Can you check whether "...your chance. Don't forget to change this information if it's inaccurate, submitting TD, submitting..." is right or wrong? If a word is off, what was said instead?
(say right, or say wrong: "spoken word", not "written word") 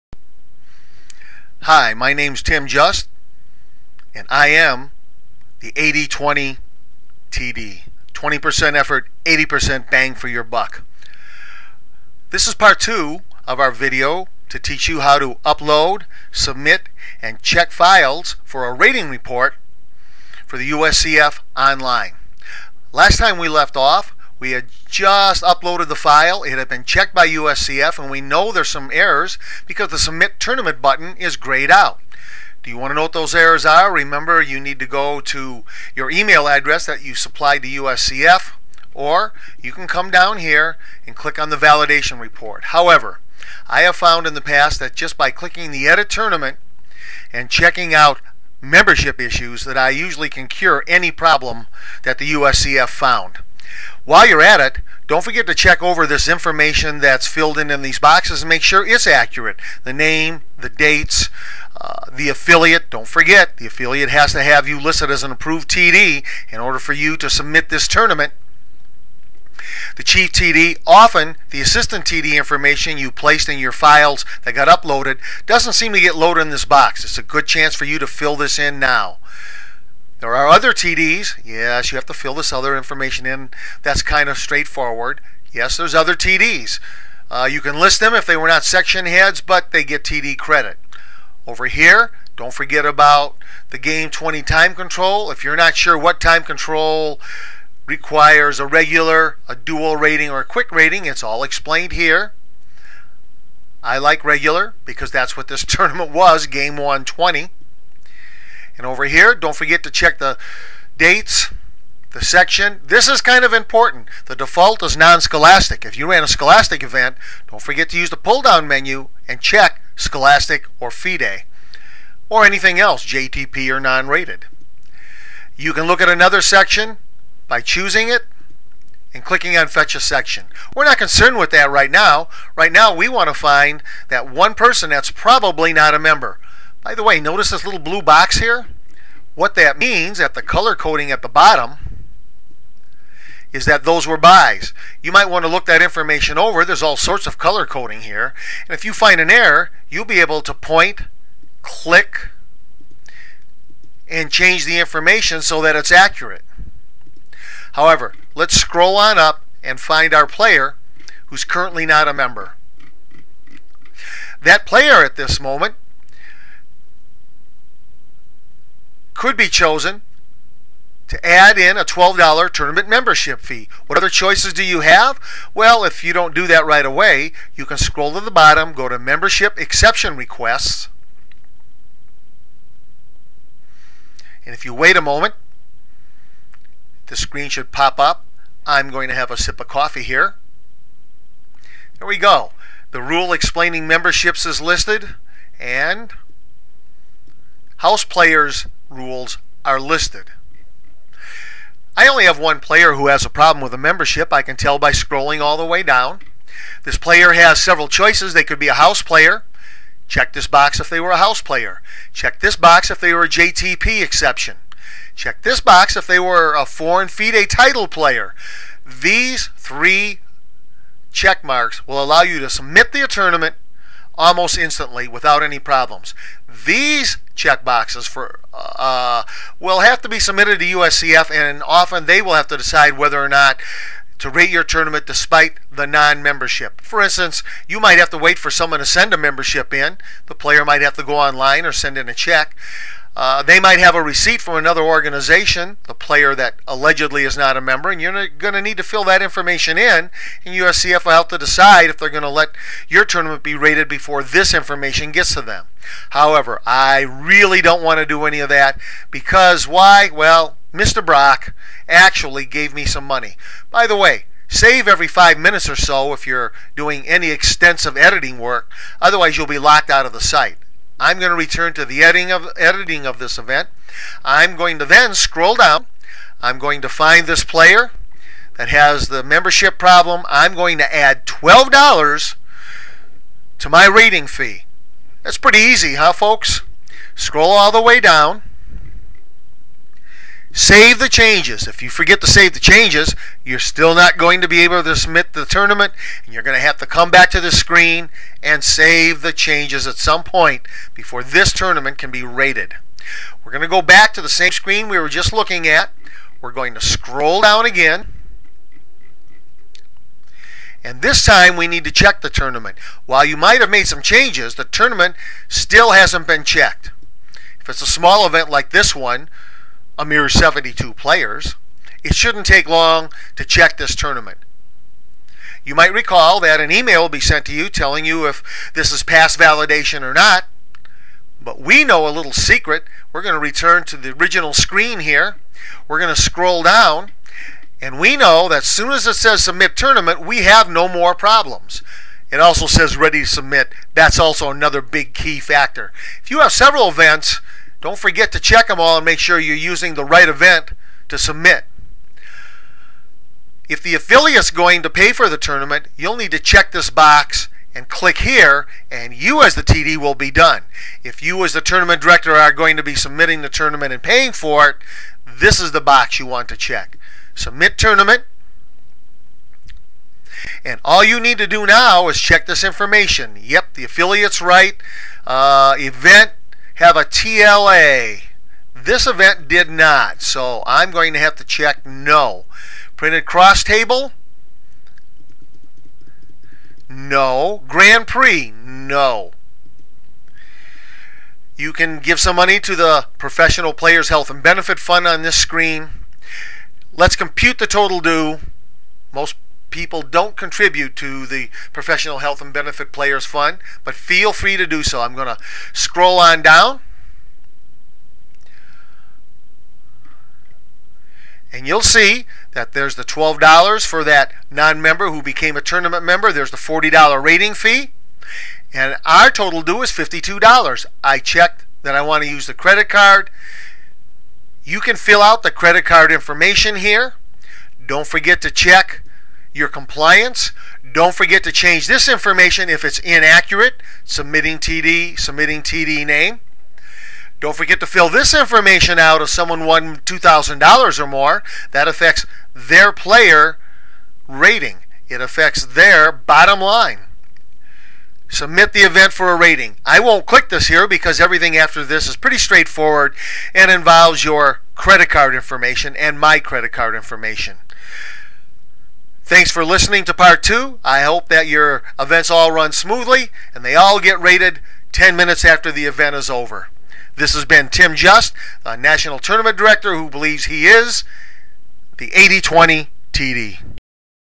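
wrong: "compliance", not "chance".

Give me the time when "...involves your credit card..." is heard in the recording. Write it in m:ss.
7:33.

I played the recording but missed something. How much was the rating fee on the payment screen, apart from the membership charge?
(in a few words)
$40.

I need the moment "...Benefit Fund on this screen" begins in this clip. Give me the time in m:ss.
6:34.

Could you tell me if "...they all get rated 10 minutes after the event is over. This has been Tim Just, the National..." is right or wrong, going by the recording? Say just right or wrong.
right.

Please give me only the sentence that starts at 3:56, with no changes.
For instance, you might have to wait for someone to send a membership in.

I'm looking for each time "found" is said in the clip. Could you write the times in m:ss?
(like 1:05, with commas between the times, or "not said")
0:43, 0:52.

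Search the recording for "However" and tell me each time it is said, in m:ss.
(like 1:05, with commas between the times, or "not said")
0:42, 2:37, 4:16.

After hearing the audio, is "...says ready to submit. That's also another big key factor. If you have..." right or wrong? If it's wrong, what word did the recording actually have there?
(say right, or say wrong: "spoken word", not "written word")
right.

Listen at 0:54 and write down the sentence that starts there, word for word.
While you're at it, don't forget to check over this information that's filled in in these boxes and make sure it's accurate.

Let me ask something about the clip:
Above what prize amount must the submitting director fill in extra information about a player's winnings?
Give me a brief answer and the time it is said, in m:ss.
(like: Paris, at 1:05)
$2,000, at 7:19.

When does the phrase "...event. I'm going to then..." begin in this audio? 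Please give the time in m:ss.
4:33.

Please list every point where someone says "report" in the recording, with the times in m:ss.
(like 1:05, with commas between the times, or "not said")
0:19, 0:42.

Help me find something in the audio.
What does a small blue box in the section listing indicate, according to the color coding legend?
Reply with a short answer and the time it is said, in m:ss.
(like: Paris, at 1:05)
byes, at 2:24.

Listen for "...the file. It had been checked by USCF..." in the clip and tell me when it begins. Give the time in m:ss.
0:25.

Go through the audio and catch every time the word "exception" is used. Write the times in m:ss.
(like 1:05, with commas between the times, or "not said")
2:59, 3:34.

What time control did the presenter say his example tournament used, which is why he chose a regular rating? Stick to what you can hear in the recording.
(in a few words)
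game 120.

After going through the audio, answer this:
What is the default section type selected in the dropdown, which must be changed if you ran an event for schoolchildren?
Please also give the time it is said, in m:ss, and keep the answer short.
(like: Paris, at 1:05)
non-scholastic, at 1:54.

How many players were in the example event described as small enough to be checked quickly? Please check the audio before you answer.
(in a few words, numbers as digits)
72.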